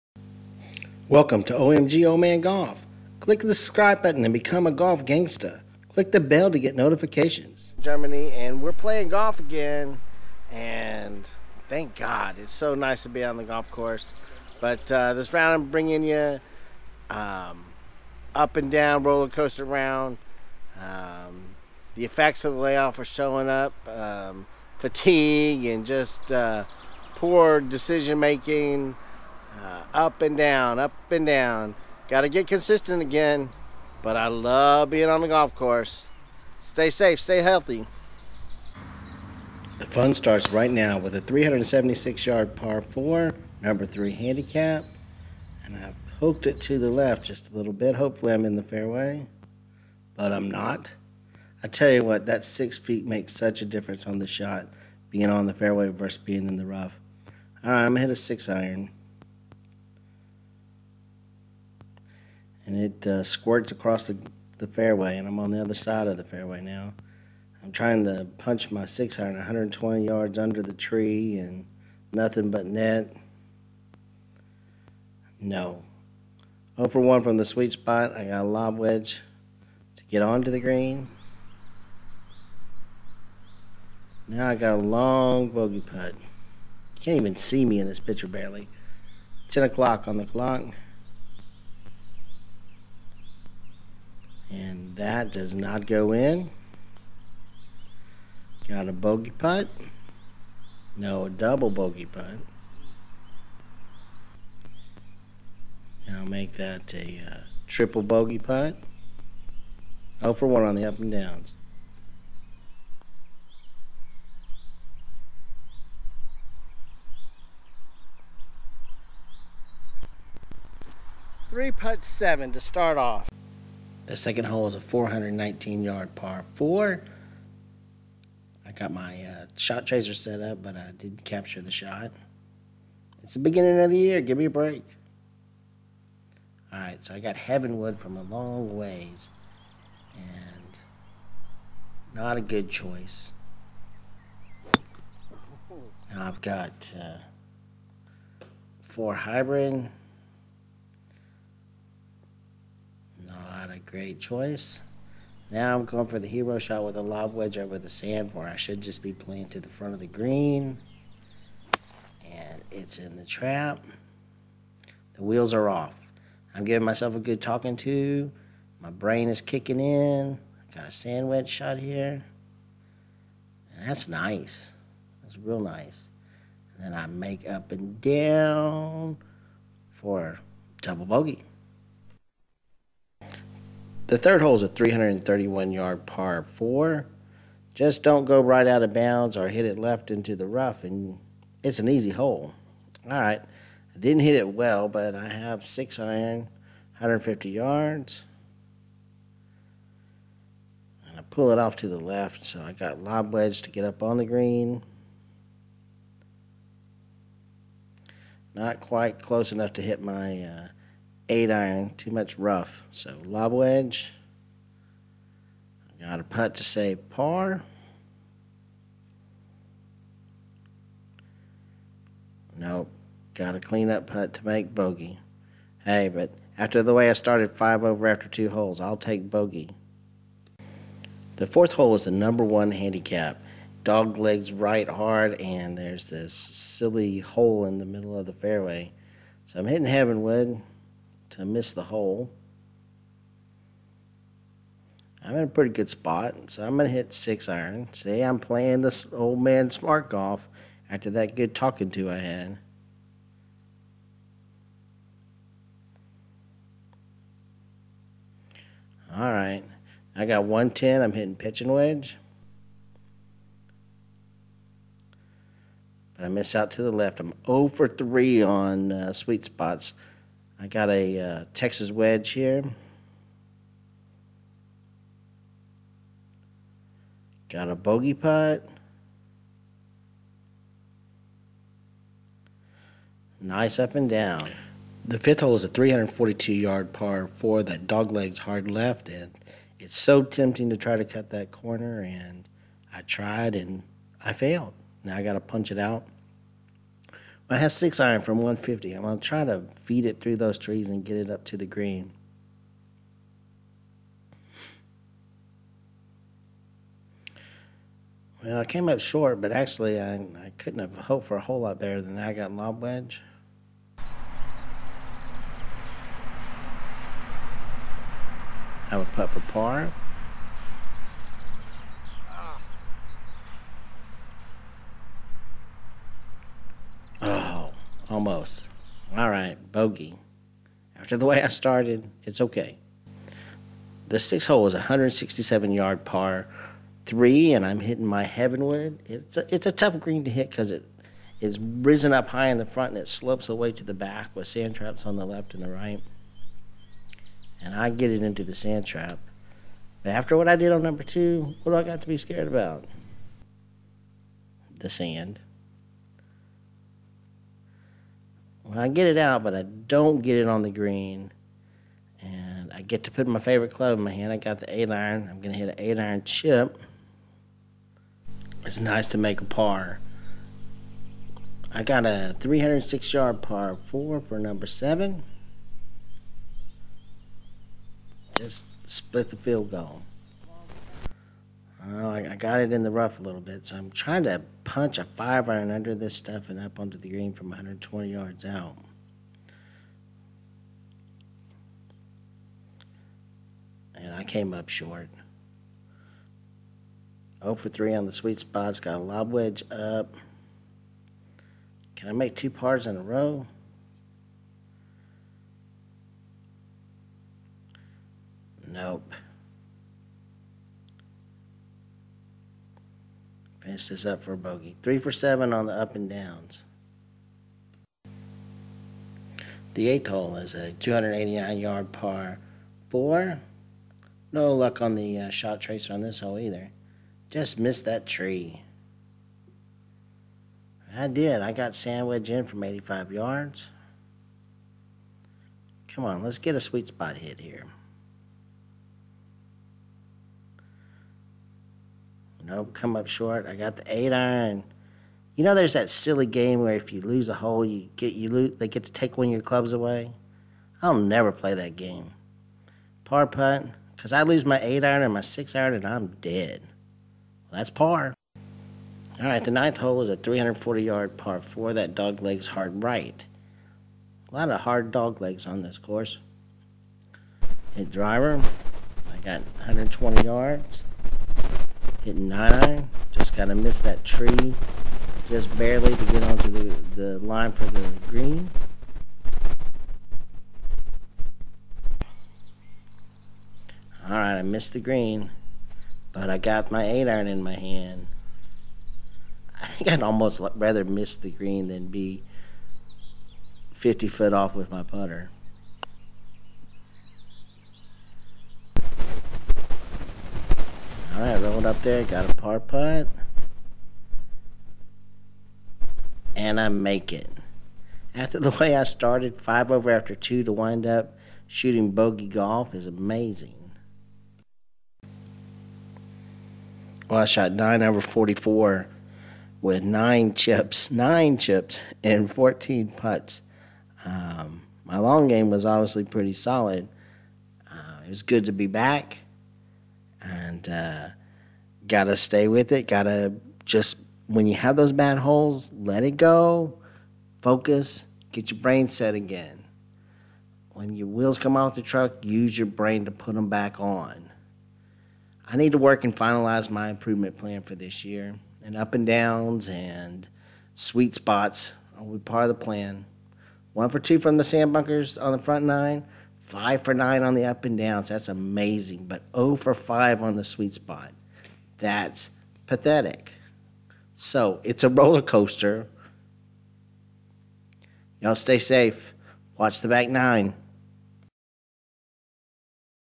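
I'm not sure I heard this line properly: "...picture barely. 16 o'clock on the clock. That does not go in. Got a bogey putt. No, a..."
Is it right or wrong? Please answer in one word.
wrong.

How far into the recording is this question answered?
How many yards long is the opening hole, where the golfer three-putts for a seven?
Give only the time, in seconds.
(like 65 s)
41 s.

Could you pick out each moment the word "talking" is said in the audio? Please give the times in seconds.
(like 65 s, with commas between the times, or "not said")
167 s, 251 s.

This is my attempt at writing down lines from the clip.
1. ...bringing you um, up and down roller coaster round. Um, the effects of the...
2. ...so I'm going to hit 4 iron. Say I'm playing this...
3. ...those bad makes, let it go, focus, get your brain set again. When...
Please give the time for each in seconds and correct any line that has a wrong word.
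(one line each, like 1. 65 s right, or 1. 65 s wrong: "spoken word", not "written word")
1. 15 s right
2. 246 s wrong: "6", not "4"
3. 534 s wrong: "holes", not "makes".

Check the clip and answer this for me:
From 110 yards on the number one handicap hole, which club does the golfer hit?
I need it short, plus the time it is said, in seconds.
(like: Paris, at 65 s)
pitching wedge, at 261 s.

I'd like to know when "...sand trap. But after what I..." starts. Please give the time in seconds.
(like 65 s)
348 s.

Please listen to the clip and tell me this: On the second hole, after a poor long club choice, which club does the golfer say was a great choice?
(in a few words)
four hybrid.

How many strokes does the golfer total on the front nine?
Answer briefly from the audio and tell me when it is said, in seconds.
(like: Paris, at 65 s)
44, at 517 s.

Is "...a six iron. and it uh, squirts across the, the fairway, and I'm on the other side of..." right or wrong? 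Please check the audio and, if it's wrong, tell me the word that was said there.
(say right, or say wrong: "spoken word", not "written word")
right.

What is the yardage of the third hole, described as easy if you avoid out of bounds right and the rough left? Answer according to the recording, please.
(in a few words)
331.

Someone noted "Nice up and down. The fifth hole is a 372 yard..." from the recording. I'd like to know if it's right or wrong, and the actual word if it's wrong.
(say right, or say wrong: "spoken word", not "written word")
wrong: "342", not "372".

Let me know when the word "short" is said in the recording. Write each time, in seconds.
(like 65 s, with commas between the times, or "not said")
309 s, 394 s, 443 s.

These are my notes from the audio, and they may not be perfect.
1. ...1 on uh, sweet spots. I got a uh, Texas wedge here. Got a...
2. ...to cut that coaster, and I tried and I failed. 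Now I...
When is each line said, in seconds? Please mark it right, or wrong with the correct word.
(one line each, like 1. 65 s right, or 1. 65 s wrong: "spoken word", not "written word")
1. 267 s wrong: "3", not "1"
2. 290 s wrong: "corner", not "coaster".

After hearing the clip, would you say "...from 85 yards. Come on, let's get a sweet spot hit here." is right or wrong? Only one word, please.
right.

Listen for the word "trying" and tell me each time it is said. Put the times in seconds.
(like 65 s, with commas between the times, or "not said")
67 s, 383 s.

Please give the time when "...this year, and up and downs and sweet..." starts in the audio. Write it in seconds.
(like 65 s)
547 s.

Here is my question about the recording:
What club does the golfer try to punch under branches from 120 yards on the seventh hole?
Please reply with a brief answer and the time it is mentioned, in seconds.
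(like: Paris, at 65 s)
five iron, at 385 s.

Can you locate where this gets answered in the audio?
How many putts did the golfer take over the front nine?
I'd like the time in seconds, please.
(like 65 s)
522 s.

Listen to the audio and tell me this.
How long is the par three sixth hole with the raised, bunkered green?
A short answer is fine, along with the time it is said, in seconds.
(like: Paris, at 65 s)
167 yards, at 334 s.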